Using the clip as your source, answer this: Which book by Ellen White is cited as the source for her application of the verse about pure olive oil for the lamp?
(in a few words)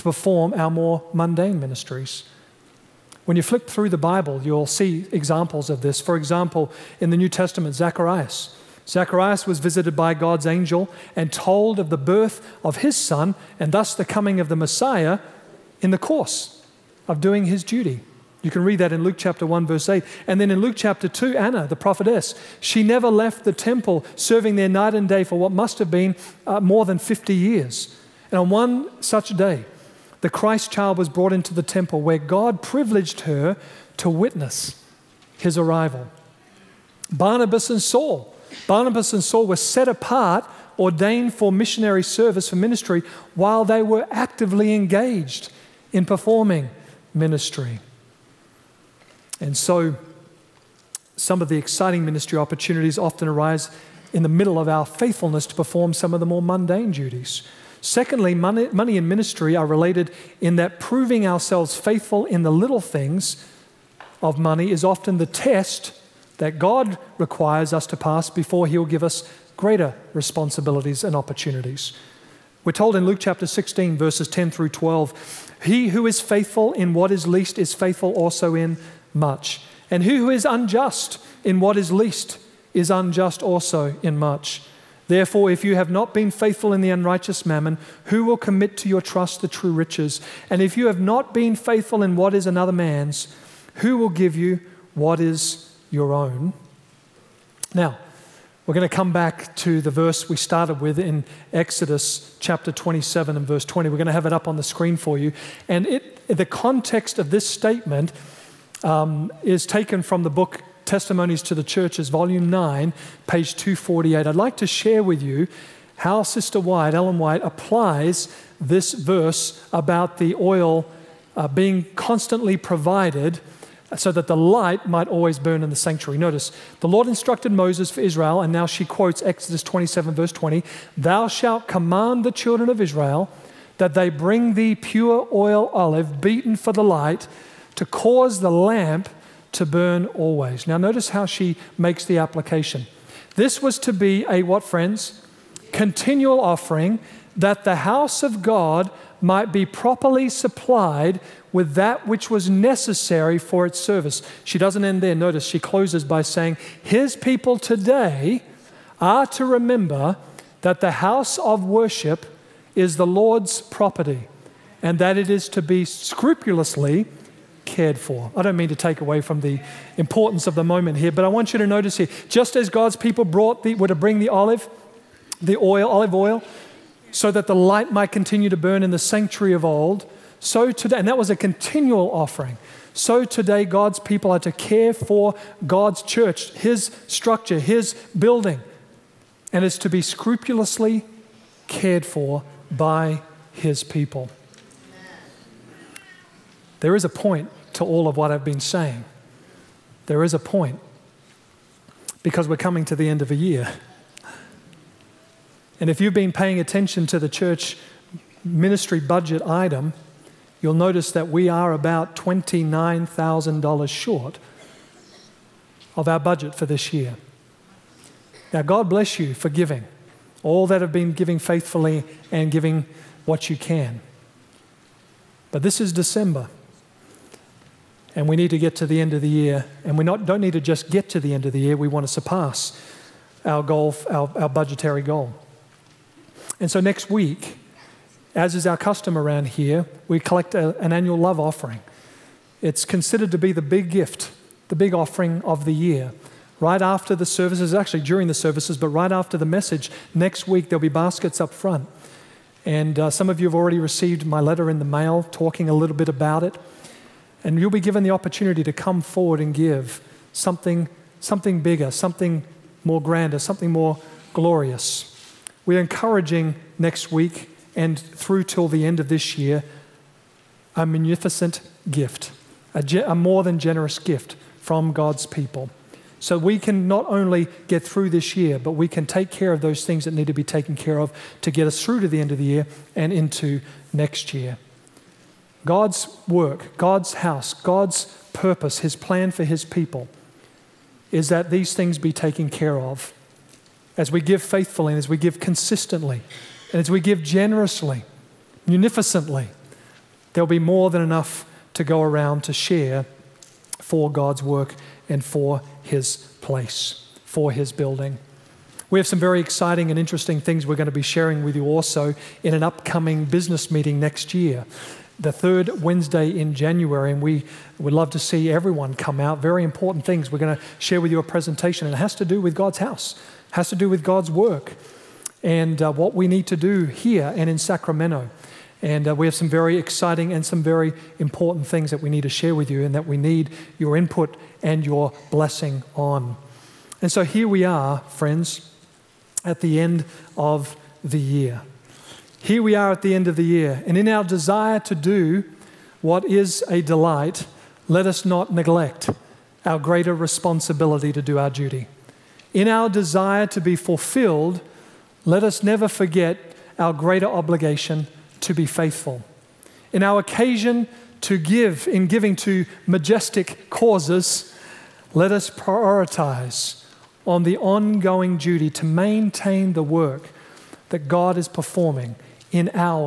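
Testimonies to the Churches, Volume 9.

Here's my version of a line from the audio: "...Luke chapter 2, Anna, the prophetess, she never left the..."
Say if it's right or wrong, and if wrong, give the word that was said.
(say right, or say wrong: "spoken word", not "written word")
right.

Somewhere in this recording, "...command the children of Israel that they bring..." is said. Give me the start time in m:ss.
2:11.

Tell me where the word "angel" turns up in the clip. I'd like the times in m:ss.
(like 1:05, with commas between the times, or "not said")
0:10.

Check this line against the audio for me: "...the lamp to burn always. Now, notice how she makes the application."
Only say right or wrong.
right.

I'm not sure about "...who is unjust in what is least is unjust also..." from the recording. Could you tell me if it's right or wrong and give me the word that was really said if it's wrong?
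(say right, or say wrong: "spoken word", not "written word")
right.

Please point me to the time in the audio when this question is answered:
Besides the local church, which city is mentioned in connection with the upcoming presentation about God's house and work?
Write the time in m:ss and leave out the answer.
5:27.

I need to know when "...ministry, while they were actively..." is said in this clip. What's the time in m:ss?
0:42.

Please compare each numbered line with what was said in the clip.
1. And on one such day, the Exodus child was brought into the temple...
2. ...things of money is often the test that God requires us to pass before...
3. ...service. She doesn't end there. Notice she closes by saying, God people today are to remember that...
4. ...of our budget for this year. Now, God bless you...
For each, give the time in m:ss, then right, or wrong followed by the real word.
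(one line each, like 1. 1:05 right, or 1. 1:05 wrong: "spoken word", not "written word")
1. 0:28 wrong: "Christ", not "Exodus"
2. 1:02 right
3. 2:33 wrong: "His", not "God"
4. 3:35 right.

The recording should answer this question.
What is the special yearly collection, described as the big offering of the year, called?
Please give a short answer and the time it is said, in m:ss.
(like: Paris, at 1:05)
annual love offering, at 4:00.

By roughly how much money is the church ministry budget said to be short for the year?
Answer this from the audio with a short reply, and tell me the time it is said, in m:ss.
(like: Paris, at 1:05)
$29,000, at 3:32.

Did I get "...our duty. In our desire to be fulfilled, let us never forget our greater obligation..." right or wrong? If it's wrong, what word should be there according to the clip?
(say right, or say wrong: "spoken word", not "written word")
right.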